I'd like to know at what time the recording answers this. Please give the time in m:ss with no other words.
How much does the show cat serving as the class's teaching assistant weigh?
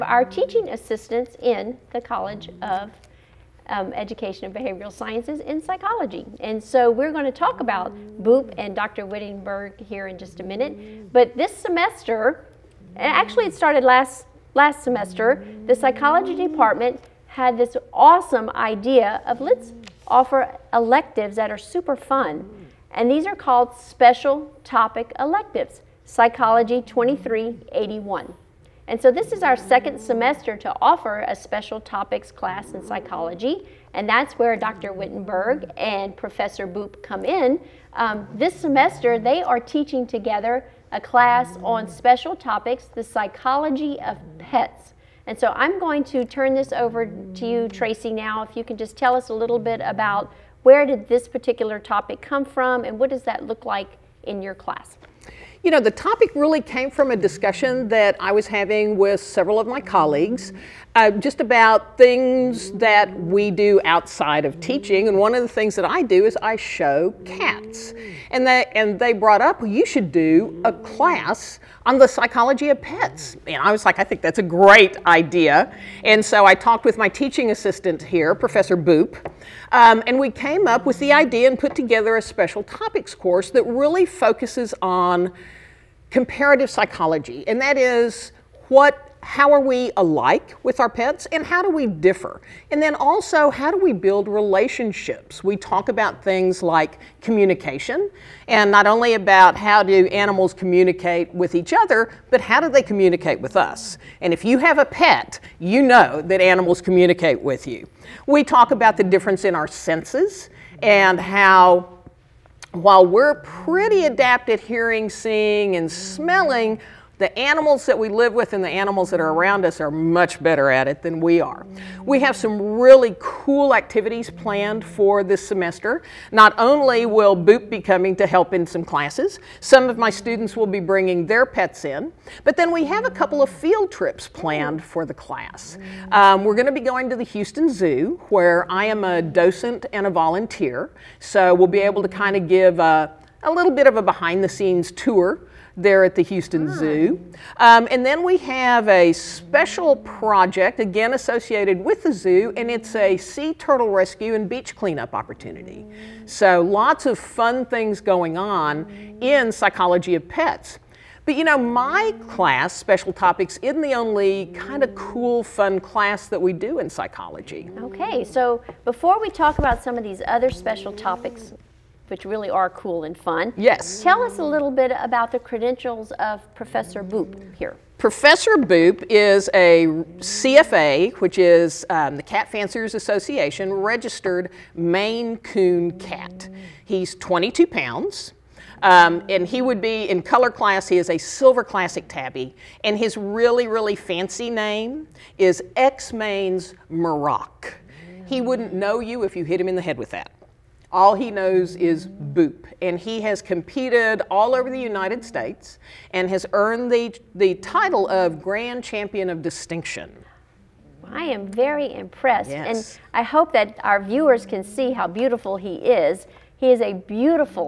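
3:07.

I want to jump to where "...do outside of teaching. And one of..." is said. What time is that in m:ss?
1:03.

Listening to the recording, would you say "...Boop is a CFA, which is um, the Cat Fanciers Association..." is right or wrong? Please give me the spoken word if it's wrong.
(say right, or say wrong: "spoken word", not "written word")
right.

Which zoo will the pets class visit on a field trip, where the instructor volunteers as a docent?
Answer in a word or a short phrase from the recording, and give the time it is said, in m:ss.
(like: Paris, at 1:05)
Houston Zoo, at 2:17.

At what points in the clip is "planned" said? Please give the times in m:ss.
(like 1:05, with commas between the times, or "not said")
2:04, 2:14.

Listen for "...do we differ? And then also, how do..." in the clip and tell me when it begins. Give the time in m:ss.
1:31.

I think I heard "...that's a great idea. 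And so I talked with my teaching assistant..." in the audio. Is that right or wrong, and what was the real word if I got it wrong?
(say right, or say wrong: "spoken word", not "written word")
right.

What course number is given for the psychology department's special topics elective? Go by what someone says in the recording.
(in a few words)
Psychology 2381.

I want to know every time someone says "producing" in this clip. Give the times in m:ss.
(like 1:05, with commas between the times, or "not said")
not said.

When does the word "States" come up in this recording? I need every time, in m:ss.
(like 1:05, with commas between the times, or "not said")
3:25.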